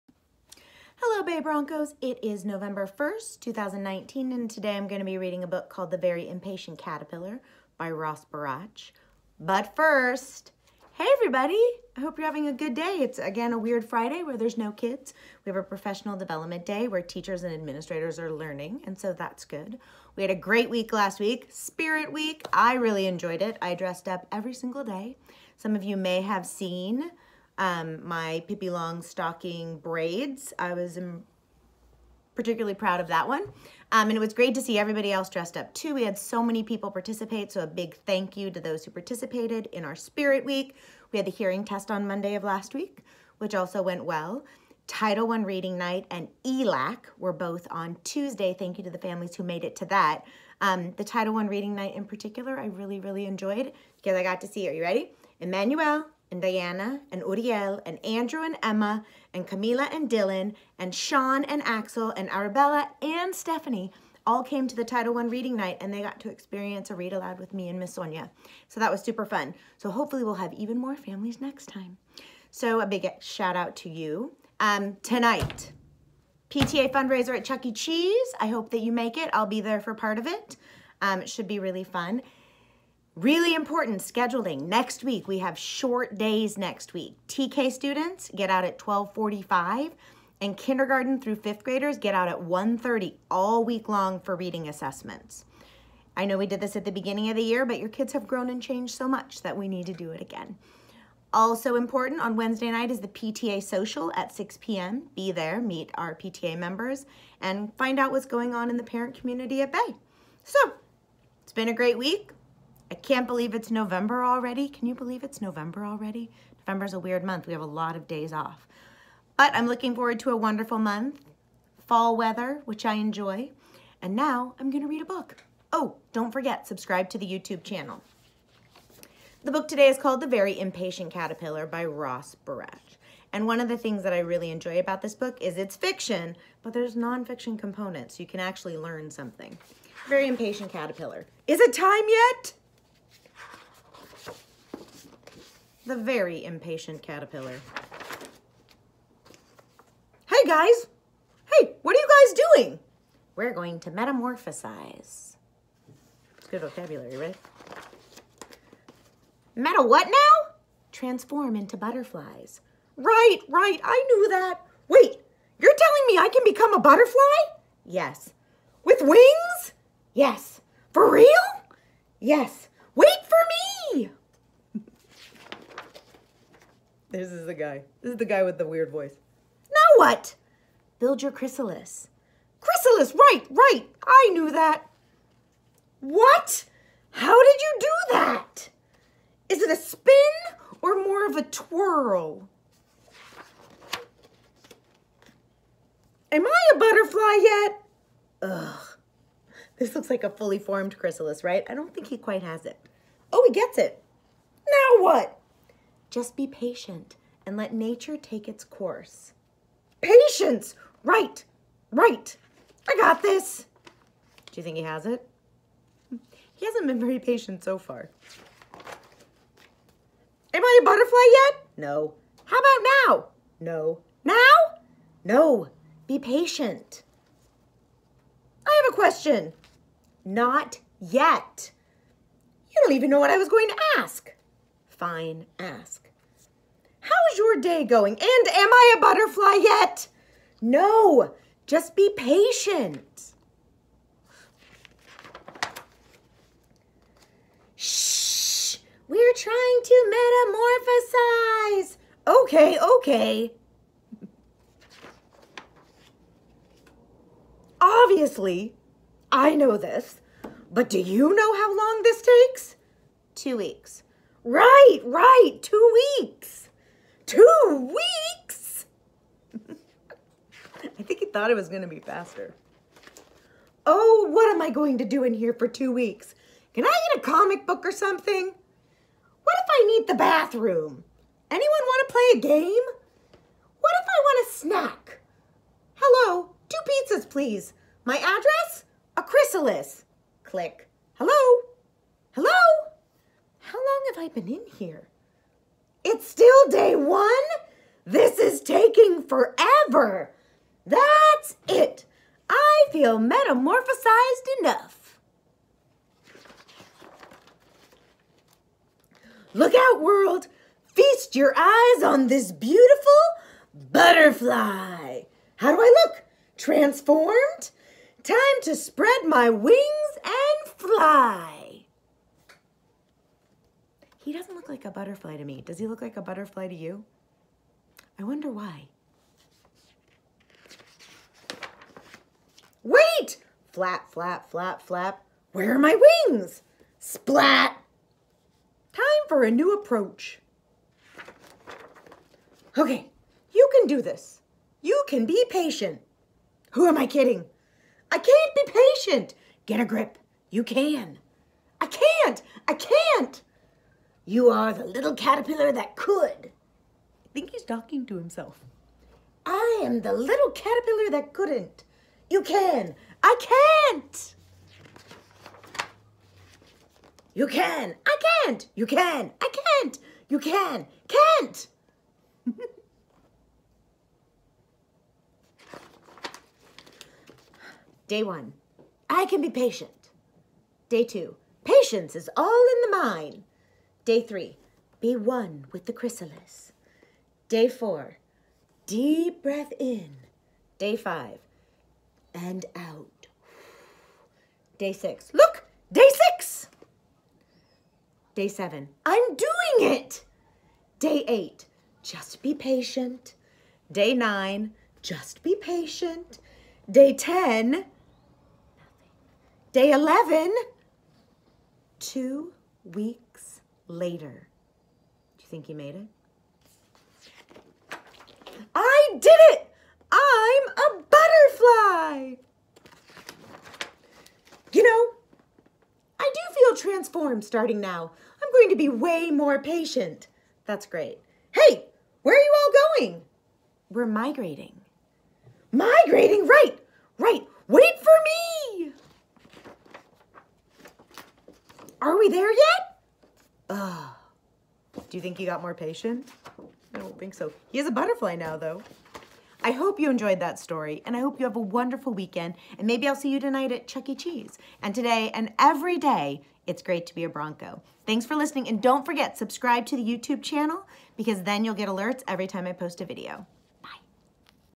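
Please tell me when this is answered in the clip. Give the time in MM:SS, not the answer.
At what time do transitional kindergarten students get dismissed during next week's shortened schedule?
01:28.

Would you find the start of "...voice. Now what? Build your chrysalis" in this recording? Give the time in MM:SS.
02:58.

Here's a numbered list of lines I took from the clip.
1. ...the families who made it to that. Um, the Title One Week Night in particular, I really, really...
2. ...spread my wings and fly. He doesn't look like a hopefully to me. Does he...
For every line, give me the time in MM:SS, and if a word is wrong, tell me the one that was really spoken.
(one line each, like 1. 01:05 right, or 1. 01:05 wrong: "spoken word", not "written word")
1. 00:48 wrong: "Reading", not "Week"
2. 05:18 wrong: "butterfly", not "hopefully".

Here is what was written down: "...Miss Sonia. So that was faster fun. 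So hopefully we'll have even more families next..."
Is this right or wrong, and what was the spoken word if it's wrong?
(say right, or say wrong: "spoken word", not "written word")
wrong: "super", not "faster".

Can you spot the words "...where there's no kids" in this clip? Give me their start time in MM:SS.
00:14.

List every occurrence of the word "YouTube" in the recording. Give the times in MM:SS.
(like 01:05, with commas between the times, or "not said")
02:07, 07:40.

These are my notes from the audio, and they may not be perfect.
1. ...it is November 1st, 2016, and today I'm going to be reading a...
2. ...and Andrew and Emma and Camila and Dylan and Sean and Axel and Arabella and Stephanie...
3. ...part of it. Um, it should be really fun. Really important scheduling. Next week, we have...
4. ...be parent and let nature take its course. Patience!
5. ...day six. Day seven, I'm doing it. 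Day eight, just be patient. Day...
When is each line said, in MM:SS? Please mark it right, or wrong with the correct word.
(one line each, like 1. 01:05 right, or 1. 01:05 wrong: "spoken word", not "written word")
1. 00:01 wrong: "2019", not "2016"
2. 00:57 right
3. 01:19 right
4. 03:26 wrong: "patient", not "parent"
5. 06:35 right.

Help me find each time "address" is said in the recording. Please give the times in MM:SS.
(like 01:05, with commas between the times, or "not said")
04:48.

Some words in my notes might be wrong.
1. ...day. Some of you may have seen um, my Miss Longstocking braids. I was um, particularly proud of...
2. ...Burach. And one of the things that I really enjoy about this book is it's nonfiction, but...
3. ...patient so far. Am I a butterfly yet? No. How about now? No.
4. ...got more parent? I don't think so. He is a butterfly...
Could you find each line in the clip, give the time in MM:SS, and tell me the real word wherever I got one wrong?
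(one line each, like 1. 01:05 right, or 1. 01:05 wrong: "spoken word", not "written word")
1. 00:24 wrong: "Pippi", not "Miss"
2. 02:12 wrong: "fiction", not "nonfiction"
3. 03:37 right
4. 07:25 wrong: "patient", not "parent".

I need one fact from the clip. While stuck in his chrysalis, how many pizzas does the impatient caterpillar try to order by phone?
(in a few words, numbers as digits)
2.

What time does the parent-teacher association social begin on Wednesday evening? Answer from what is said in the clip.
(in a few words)
6 p.m.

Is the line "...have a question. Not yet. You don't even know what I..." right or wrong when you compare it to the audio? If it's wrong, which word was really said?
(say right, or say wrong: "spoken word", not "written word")
right.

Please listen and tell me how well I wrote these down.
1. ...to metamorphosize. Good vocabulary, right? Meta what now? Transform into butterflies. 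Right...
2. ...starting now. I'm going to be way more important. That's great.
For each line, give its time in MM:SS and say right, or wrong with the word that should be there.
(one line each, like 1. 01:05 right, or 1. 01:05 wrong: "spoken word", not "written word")
1. 02:33 right
2. 07:07 wrong: "patient", not "important".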